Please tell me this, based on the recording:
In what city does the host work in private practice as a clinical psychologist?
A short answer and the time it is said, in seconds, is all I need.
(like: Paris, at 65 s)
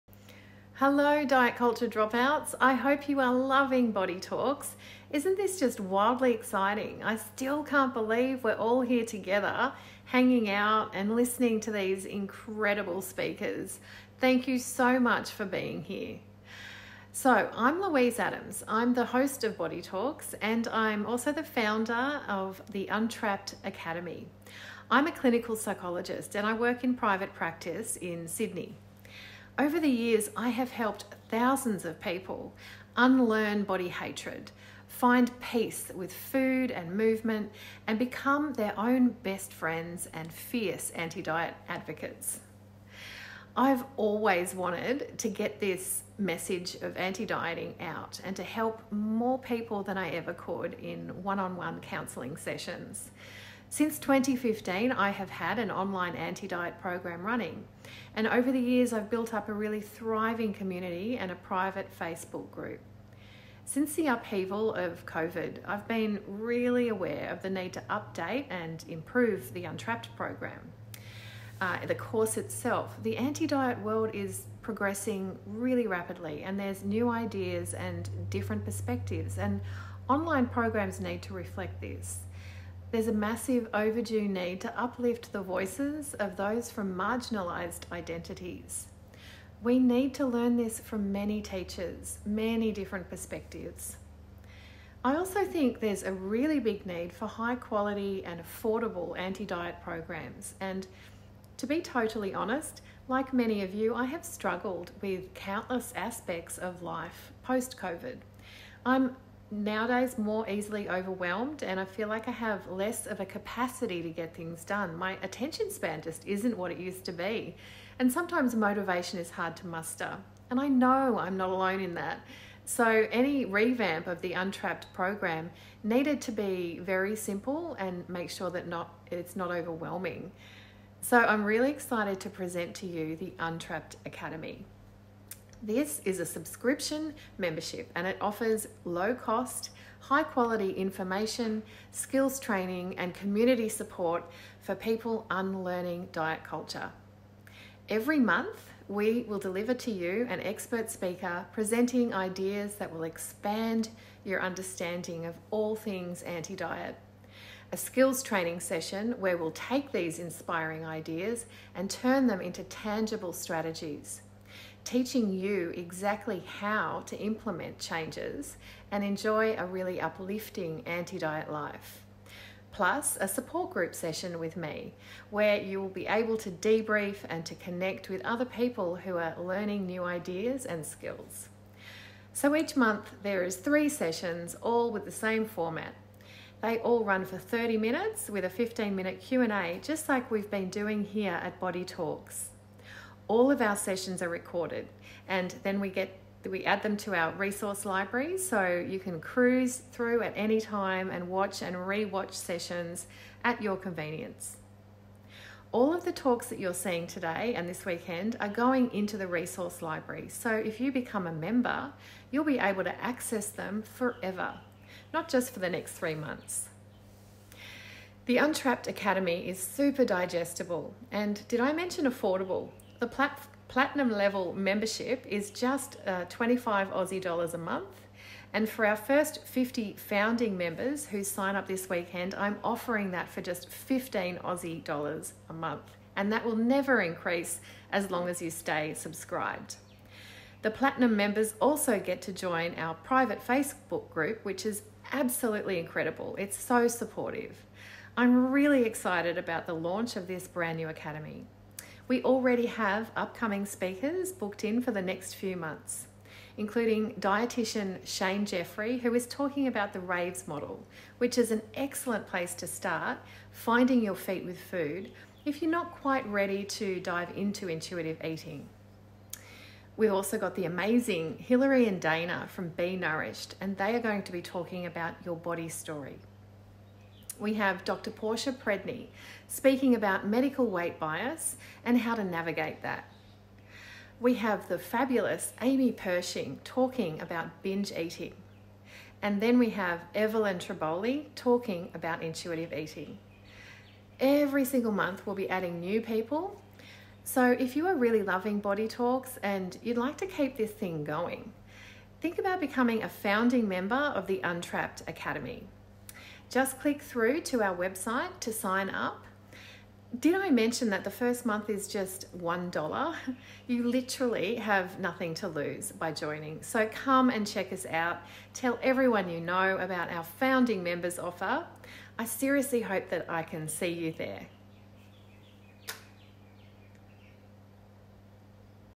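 Sydney, at 28 s.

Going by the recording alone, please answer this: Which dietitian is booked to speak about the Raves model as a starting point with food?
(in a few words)
Shane Jeffrey.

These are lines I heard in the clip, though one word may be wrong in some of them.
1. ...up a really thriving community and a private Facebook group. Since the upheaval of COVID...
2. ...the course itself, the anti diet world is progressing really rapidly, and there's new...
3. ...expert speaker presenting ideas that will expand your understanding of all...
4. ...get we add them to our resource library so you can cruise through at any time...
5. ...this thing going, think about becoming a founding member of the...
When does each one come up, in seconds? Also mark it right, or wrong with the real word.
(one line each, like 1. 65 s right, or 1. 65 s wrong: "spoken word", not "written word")
1. 59 s right
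2. 71 s right
3. 150 s right
4. 195 s right
5. 300 s right.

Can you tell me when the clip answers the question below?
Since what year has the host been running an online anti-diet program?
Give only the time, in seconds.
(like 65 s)
53 s.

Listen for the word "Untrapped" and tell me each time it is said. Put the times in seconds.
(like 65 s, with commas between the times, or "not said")
22 s, 69 s, 124 s, 133 s, 218 s, 304 s.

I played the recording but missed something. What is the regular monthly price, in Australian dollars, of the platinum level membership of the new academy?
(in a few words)
25.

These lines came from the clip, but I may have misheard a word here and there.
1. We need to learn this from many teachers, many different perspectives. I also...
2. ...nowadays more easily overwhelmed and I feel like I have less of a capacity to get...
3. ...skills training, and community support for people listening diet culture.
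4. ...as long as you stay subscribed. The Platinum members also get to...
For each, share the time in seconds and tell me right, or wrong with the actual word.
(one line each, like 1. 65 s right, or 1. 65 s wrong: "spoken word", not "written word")
1. 89 s right
2. 109 s right
3. 141 s wrong: "unlearning", not "listening"
4. 237 s right.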